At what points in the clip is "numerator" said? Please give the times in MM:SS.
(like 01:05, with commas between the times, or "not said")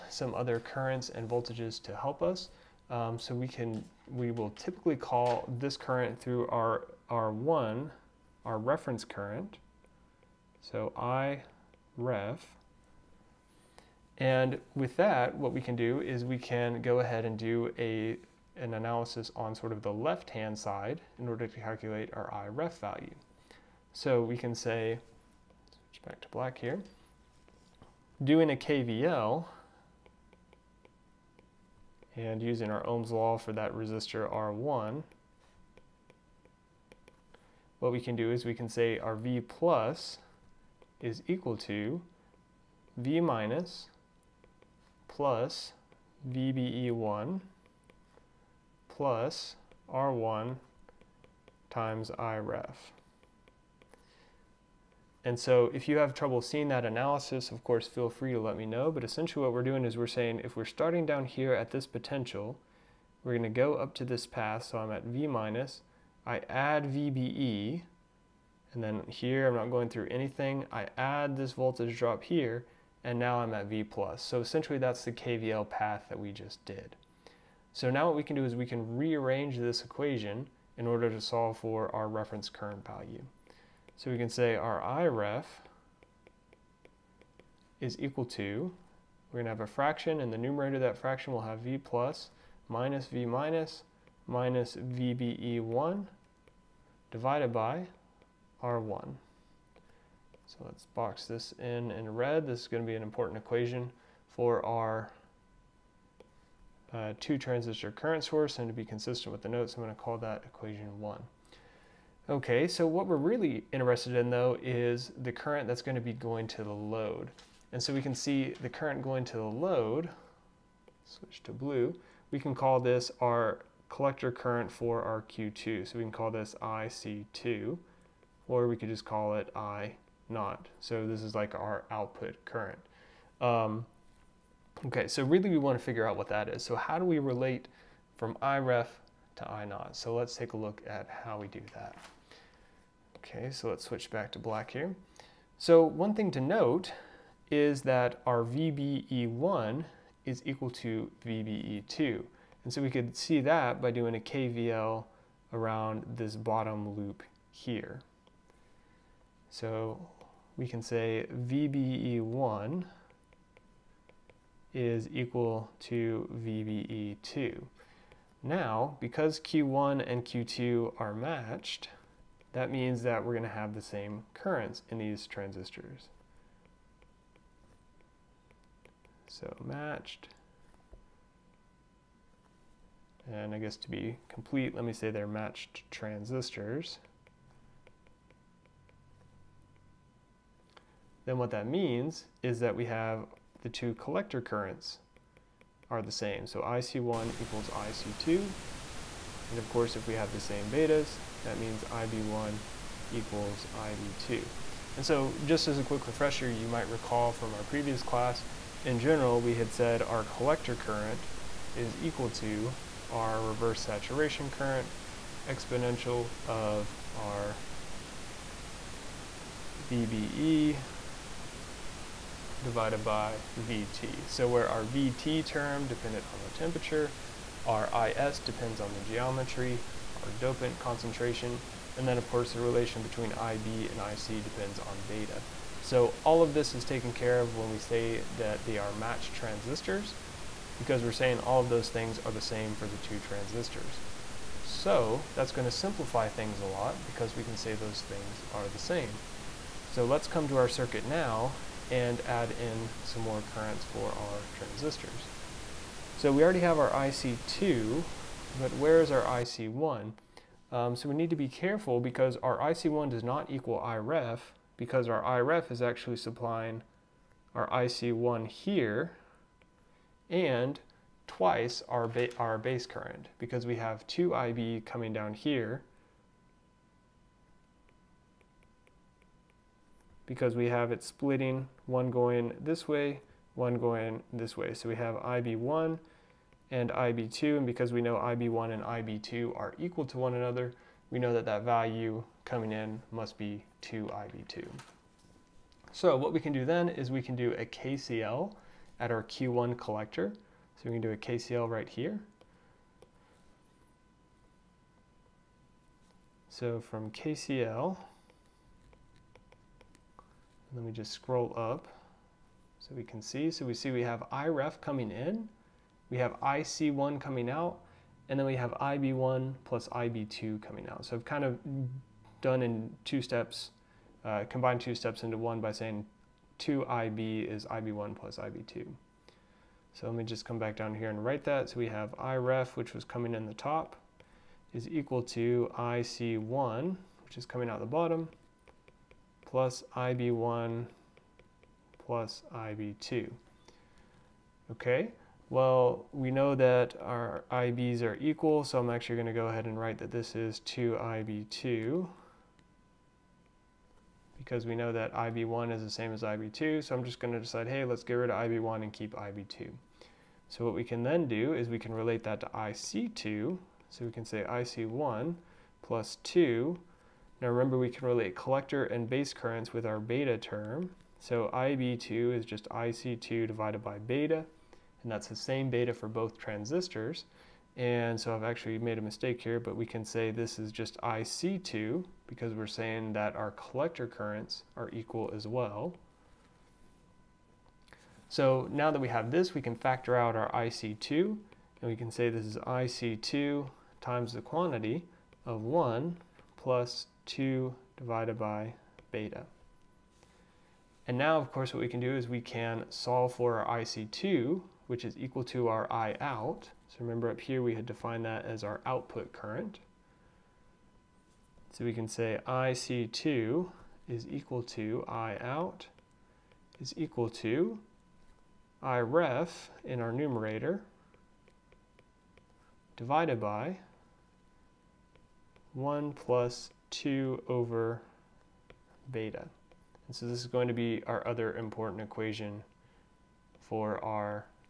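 01:30, 07:00.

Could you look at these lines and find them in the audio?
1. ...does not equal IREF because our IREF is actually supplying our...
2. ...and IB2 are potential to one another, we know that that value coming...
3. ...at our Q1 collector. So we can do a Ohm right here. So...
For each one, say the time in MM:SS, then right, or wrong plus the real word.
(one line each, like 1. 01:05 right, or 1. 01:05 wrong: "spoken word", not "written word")
1. 04:23 right
2. 04:48 wrong: "equal", not "potential"
3. 04:58 wrong: "KCL", not "Ohm".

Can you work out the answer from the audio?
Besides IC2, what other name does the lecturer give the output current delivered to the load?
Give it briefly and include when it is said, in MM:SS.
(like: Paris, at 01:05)
I not, at 02:09.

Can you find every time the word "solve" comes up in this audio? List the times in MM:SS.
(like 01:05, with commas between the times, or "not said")
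01:21, 06:42.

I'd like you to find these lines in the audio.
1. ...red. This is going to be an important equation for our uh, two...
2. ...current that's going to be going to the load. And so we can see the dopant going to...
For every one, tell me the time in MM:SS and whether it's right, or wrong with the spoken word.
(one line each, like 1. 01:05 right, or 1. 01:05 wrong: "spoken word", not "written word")
1. 01:42 right
2. 01:55 wrong: "current", not "dopant".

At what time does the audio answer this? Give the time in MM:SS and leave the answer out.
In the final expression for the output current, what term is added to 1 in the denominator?
07:06.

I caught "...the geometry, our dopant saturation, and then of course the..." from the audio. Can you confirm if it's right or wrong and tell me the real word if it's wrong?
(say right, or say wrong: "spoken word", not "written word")
wrong: "concentration", not "saturation".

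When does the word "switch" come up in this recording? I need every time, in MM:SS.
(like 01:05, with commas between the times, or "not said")
00:25, 02:01, 02:23.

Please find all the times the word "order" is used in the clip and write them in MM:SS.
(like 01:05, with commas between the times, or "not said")
00:21, 01:20.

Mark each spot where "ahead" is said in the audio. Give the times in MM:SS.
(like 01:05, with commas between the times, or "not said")
00:16, 05:49.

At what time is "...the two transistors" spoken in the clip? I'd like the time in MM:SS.
04:02.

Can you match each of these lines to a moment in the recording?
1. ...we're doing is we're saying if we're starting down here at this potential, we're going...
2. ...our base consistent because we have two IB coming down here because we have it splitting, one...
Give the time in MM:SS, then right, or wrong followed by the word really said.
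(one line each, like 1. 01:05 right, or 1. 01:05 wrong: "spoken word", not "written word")
1. 00:59 right
2. 04:32 wrong: "current", not "consistent".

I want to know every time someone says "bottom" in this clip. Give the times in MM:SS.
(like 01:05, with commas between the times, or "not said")
02:36, 05:37.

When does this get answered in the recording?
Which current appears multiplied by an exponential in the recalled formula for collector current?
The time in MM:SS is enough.
03:33.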